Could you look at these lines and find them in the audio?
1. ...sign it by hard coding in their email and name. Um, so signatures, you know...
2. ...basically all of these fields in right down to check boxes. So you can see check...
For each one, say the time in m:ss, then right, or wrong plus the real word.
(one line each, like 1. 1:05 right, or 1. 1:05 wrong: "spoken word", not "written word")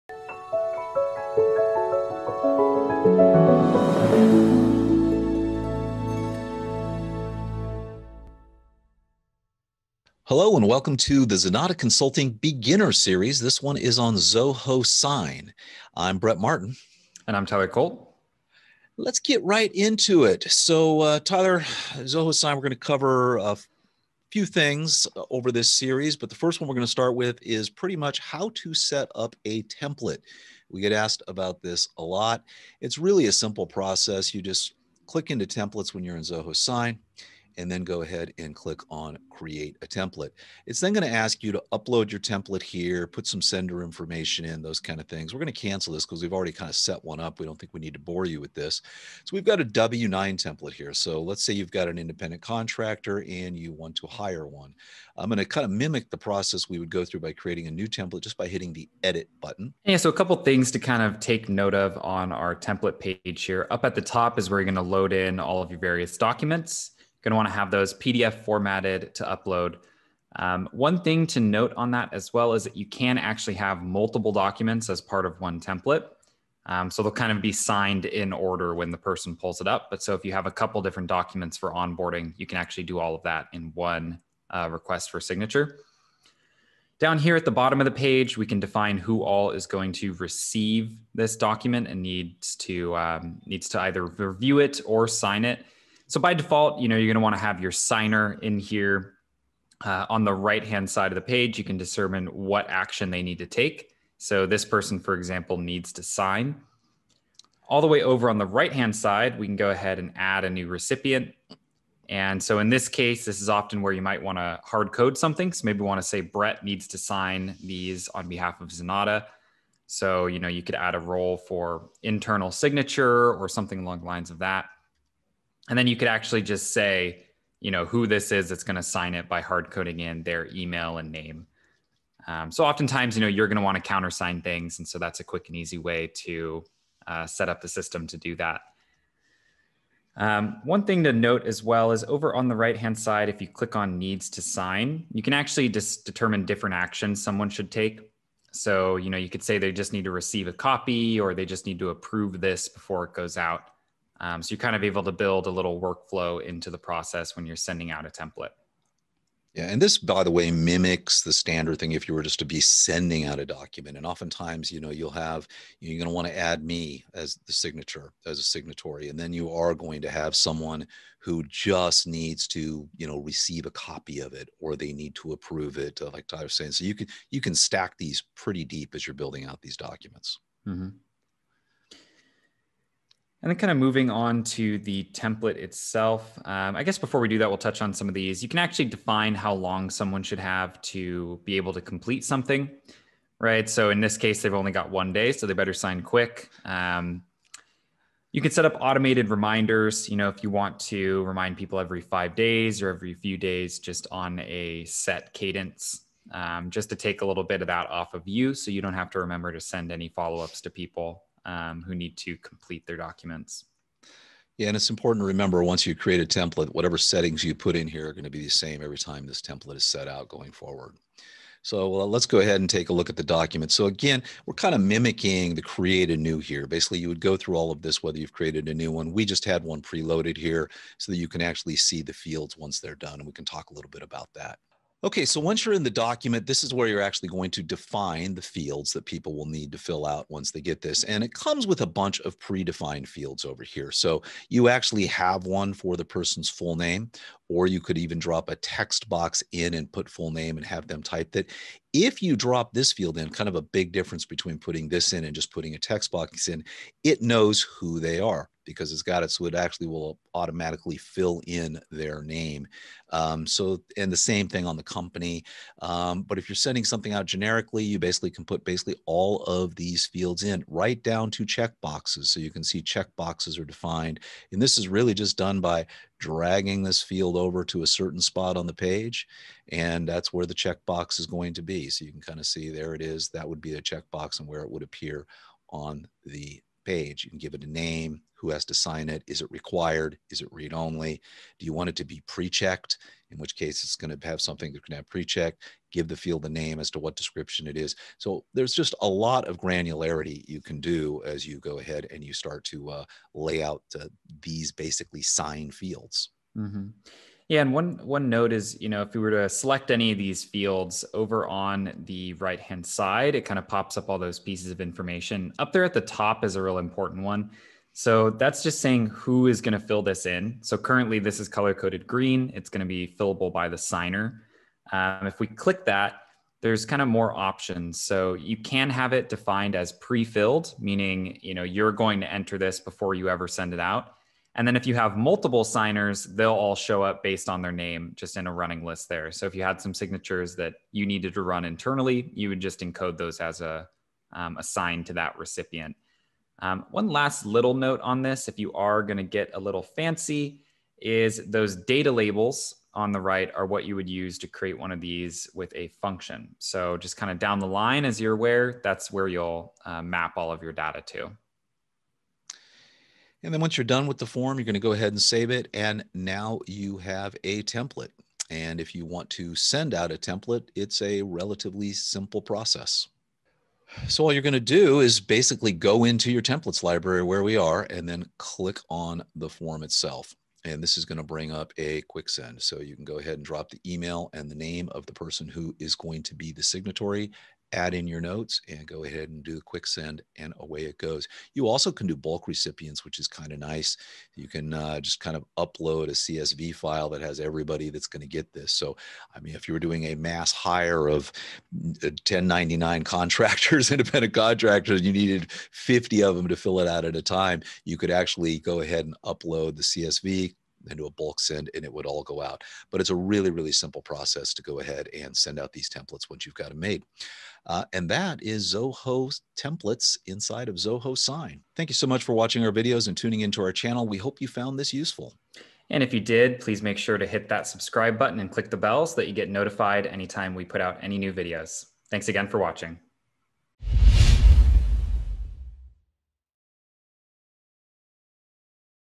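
1. 2:08 wrong: "oftentimes", not "signatures"
2. 4:28 right.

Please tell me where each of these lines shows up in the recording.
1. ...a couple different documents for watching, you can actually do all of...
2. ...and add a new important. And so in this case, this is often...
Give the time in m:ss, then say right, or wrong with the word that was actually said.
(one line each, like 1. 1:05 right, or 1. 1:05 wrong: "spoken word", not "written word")
1. 1:20 wrong: "onboarding", not "watching"
2. 1:49 wrong: "recipient", not "important".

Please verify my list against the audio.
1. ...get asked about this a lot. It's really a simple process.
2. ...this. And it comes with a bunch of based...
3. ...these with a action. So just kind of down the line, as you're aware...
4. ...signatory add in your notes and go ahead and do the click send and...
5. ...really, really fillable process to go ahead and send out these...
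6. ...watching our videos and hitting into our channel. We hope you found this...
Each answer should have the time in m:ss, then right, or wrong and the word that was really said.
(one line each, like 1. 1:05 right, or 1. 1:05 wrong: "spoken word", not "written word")
1. 0:30 right
2. 4:00 wrong: "predefined", not "based"
3. 5:54 wrong: "function", not "action"
4. 6:26 wrong: "quick", not "click"
5. 6:53 wrong: "simple", not "fillable"
6. 7:02 wrong: "tuning", not "hitting".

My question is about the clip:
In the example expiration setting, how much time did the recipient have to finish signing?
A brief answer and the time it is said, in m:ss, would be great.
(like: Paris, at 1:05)
1 day, at 3:14.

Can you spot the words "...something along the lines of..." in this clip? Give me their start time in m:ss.
2:03.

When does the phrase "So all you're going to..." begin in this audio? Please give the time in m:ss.
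6:14.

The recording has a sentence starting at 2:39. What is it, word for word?
Yeah, and this, by the way, mimics the standard thing if you were just to be sending out a document.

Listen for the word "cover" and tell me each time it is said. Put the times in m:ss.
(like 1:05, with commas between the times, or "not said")
0:22.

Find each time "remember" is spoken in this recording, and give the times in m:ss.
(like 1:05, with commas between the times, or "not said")
3:29, 3:35.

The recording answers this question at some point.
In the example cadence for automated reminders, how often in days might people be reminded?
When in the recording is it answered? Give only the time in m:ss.
3:22.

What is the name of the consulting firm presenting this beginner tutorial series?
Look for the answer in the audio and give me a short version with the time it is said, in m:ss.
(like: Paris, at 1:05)
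Zenatta Consulting, at 0:11.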